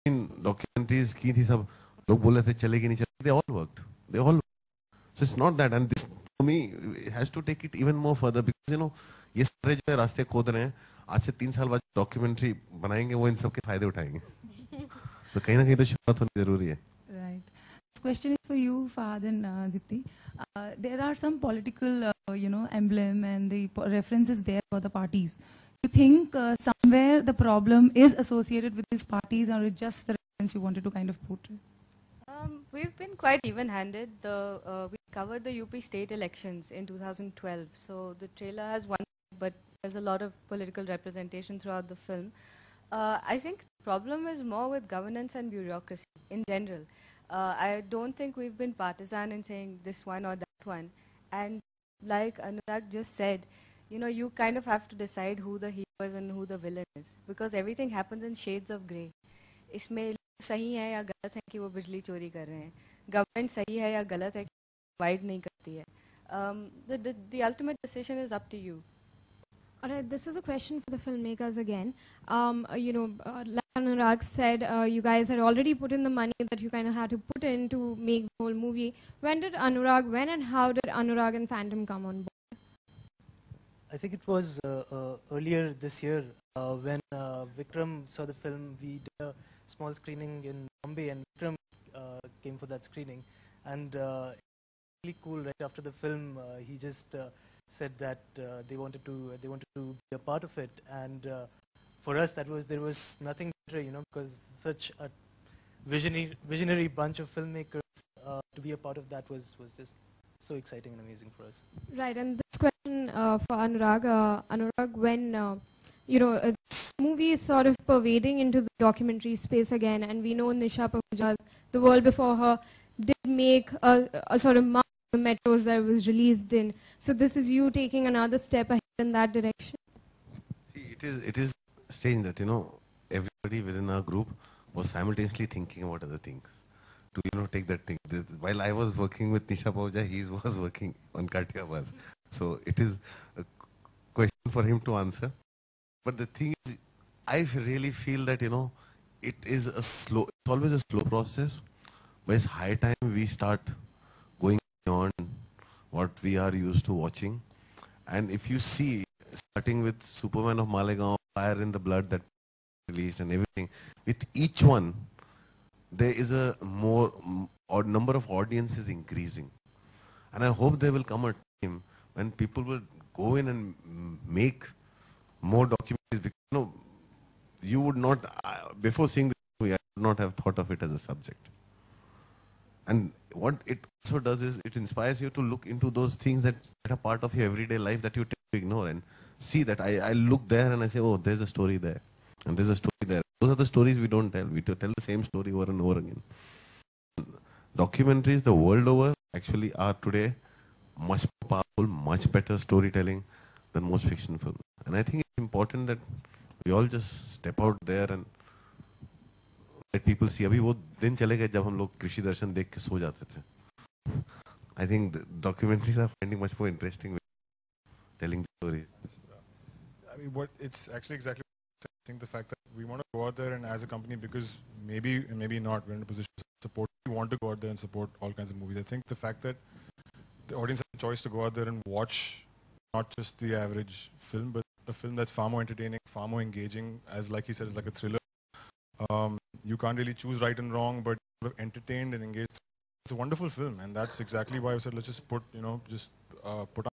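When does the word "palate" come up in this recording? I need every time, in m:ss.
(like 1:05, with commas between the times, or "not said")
not said.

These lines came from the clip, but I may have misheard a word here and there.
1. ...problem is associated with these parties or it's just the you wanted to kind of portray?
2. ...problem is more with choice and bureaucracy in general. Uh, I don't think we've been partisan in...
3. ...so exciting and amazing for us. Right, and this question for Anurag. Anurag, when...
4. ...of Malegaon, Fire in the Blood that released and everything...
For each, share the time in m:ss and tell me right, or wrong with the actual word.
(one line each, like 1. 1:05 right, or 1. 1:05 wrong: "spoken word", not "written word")
1. 0:27 right
2. 0:43 wrong: "governance", not "choice"
3. 1:50 right
4. 2:40 right.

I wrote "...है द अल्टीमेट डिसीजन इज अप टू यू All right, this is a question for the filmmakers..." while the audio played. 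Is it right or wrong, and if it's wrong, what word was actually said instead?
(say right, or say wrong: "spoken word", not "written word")
right.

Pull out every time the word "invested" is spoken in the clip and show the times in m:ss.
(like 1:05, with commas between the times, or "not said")
not said.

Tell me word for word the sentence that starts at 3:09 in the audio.
I, I look there and I say, oh, there's a story there.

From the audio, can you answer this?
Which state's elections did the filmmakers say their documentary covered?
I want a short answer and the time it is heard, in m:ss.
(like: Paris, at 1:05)
UP, at 0:35.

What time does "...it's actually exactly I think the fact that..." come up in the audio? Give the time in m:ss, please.
3:40.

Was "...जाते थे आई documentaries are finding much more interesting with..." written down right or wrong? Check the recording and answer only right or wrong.
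right.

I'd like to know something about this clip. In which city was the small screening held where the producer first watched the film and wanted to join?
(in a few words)
Bombay.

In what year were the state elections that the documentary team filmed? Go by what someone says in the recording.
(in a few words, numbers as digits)
2012.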